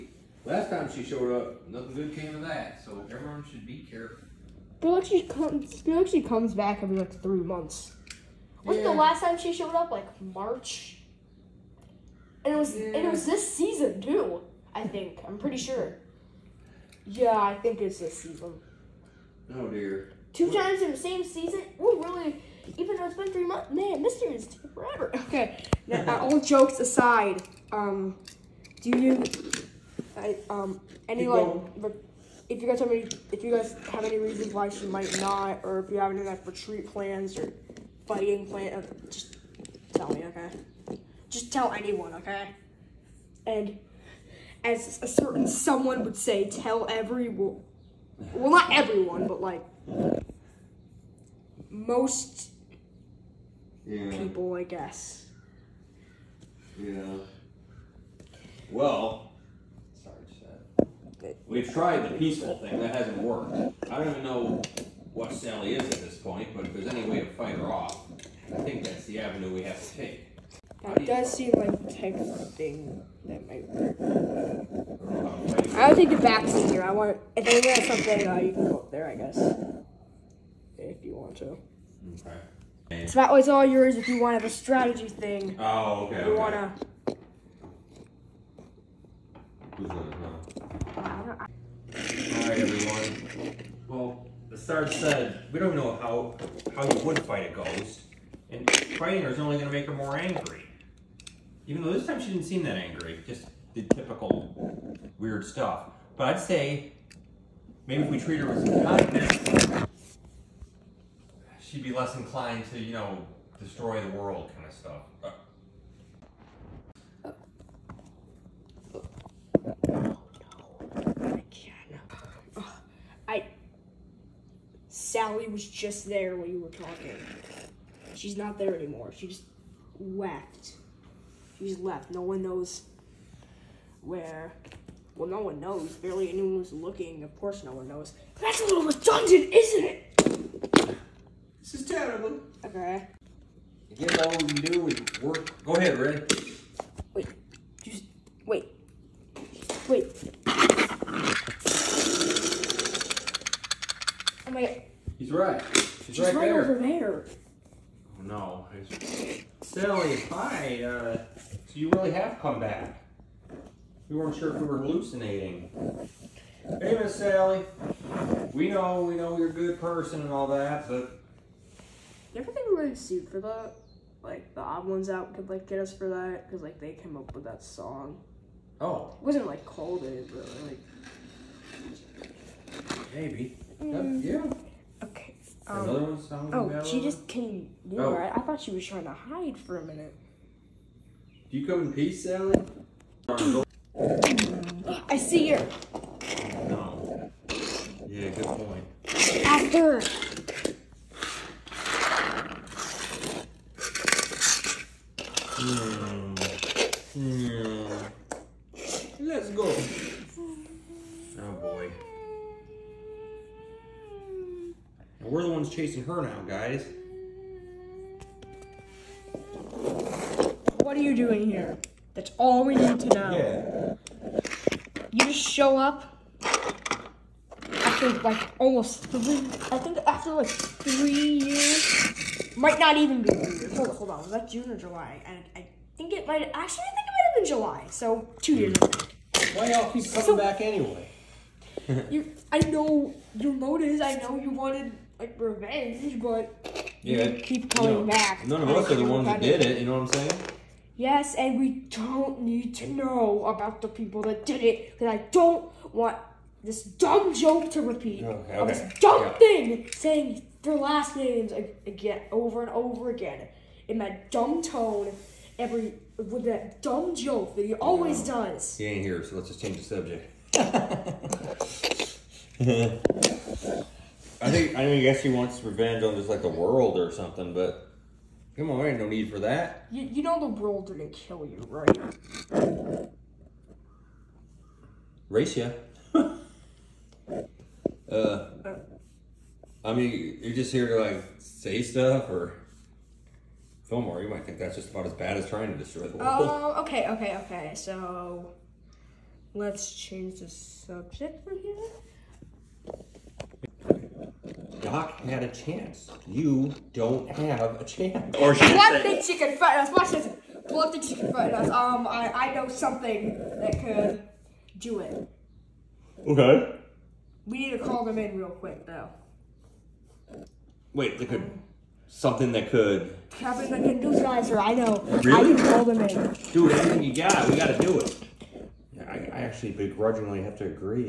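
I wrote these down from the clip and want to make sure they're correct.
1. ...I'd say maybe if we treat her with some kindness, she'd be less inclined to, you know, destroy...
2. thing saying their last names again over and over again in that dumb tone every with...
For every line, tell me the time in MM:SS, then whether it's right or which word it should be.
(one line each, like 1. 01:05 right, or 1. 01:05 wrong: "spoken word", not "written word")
1. 01:46 right
2. 04:19 right.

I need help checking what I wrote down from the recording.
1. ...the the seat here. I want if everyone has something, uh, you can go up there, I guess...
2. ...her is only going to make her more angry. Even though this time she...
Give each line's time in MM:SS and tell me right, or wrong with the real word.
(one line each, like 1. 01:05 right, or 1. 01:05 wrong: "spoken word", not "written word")
1. 01:16 wrong: "anyone", not "everyone"
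2. 01:39 right.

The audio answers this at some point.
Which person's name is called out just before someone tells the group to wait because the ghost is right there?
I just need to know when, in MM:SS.
02:25.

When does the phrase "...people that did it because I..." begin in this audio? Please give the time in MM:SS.
04:13.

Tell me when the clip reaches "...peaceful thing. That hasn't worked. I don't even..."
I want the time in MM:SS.
01:02.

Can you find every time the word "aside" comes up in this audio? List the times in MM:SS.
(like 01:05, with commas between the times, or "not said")
00:26.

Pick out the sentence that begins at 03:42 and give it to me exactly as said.
That's all we need to know.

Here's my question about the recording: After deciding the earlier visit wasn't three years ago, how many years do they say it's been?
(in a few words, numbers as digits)
2.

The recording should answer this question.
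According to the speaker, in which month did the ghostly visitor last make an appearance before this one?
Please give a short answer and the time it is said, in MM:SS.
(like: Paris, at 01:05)
March, at 00:09.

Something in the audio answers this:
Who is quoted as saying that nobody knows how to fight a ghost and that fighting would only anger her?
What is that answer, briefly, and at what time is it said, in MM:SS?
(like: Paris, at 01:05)
the Sarge, at 01:34.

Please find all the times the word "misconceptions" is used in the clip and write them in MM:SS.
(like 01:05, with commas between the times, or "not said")
not said.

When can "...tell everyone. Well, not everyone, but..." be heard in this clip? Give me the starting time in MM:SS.
00:46.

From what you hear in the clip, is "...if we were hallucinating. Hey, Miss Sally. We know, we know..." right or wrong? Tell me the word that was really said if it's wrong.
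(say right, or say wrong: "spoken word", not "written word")
right.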